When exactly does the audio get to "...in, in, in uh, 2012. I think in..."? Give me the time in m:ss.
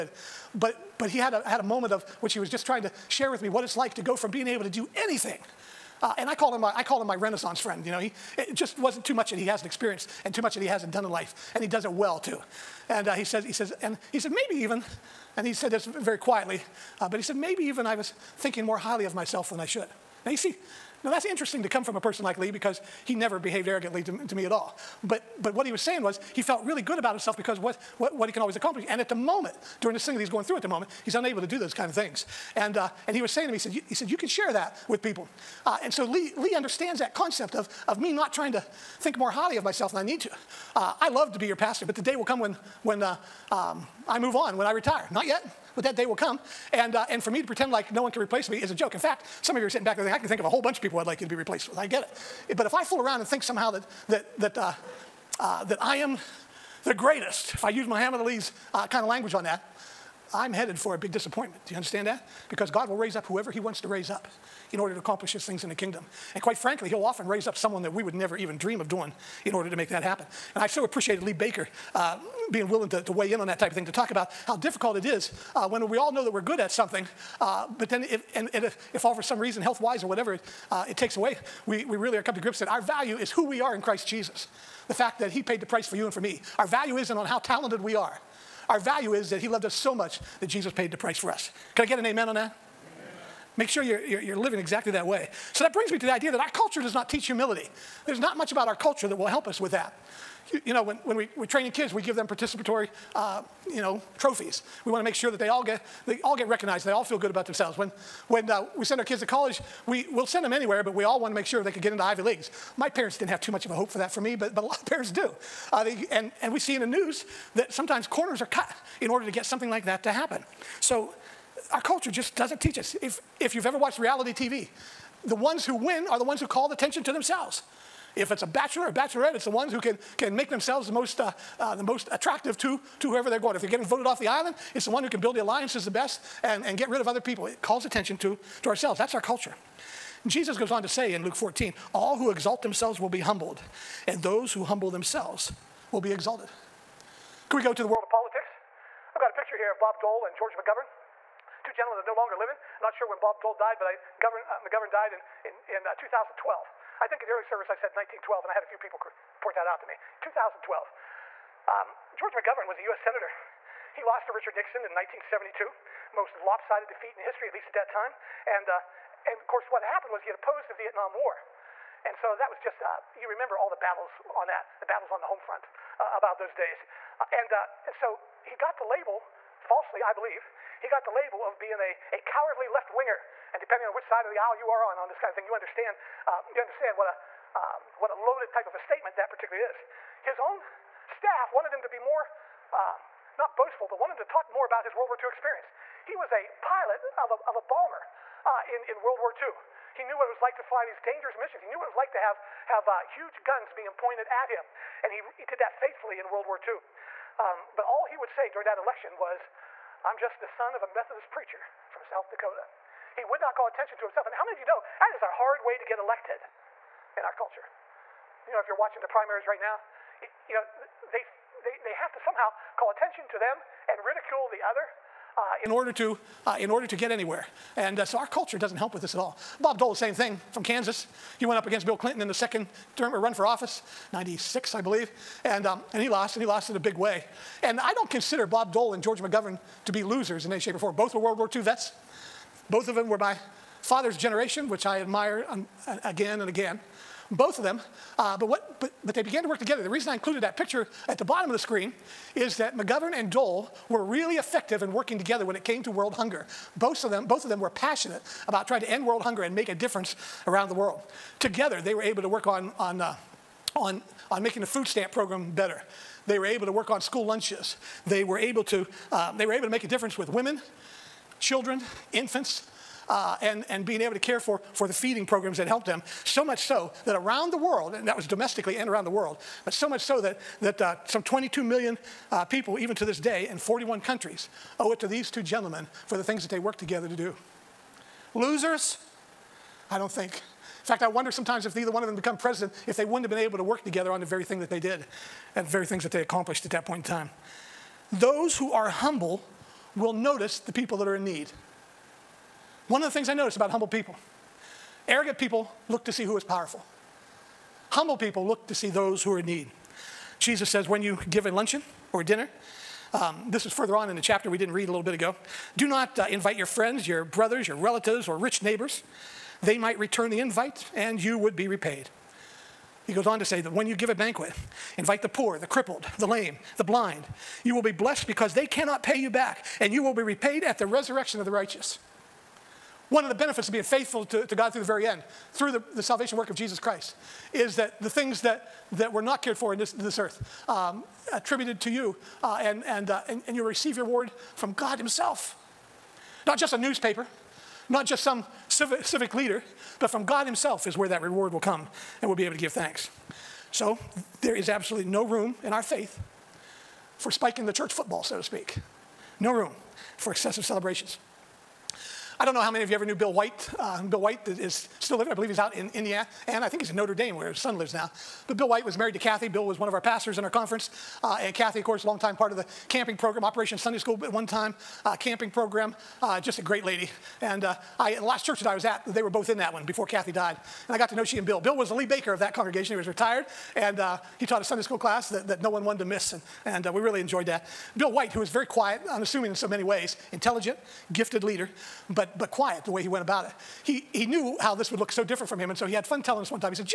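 2:35.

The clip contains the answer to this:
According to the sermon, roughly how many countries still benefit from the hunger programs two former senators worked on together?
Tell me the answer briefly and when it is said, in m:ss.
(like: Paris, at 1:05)
41, at 4:43.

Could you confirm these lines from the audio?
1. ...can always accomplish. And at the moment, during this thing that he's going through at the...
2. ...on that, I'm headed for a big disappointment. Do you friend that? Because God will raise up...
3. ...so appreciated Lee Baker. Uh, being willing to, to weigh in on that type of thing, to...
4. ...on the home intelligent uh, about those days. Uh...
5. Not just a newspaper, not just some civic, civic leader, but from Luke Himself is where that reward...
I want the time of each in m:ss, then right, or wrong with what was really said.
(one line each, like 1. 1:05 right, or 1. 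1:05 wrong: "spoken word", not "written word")
1. 0:28 right
2. 0:59 wrong: "understand", not "friend"
3. 1:10 right
4. 2:55 wrong: "front", not "intelligent"
5. 5:46 wrong: "God", not "Luke".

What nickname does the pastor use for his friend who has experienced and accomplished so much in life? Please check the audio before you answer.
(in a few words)
Renaissance friend.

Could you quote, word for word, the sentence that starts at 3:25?
And he, he did that faithfully in World War II.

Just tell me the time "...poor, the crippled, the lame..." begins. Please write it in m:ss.
5:25.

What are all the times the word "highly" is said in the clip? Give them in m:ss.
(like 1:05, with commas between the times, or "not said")
0:18, 0:39.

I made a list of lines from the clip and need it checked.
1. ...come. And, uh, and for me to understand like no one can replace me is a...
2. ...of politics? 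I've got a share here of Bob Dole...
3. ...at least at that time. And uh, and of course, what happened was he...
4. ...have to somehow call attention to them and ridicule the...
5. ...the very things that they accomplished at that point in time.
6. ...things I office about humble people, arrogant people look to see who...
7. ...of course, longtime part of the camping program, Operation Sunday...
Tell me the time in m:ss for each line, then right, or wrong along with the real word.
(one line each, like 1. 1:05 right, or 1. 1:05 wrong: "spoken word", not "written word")
1. 0:46 wrong: "pretend", not "understand"
2. 2:28 wrong: "picture", not "share"
3. 2:47 right
4. 3:41 right
5. 4:55 right
6. 5:03 wrong: "notice", not "office"
7. 6:11 right.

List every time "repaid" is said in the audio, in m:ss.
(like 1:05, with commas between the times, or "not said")
5:21, 5:30.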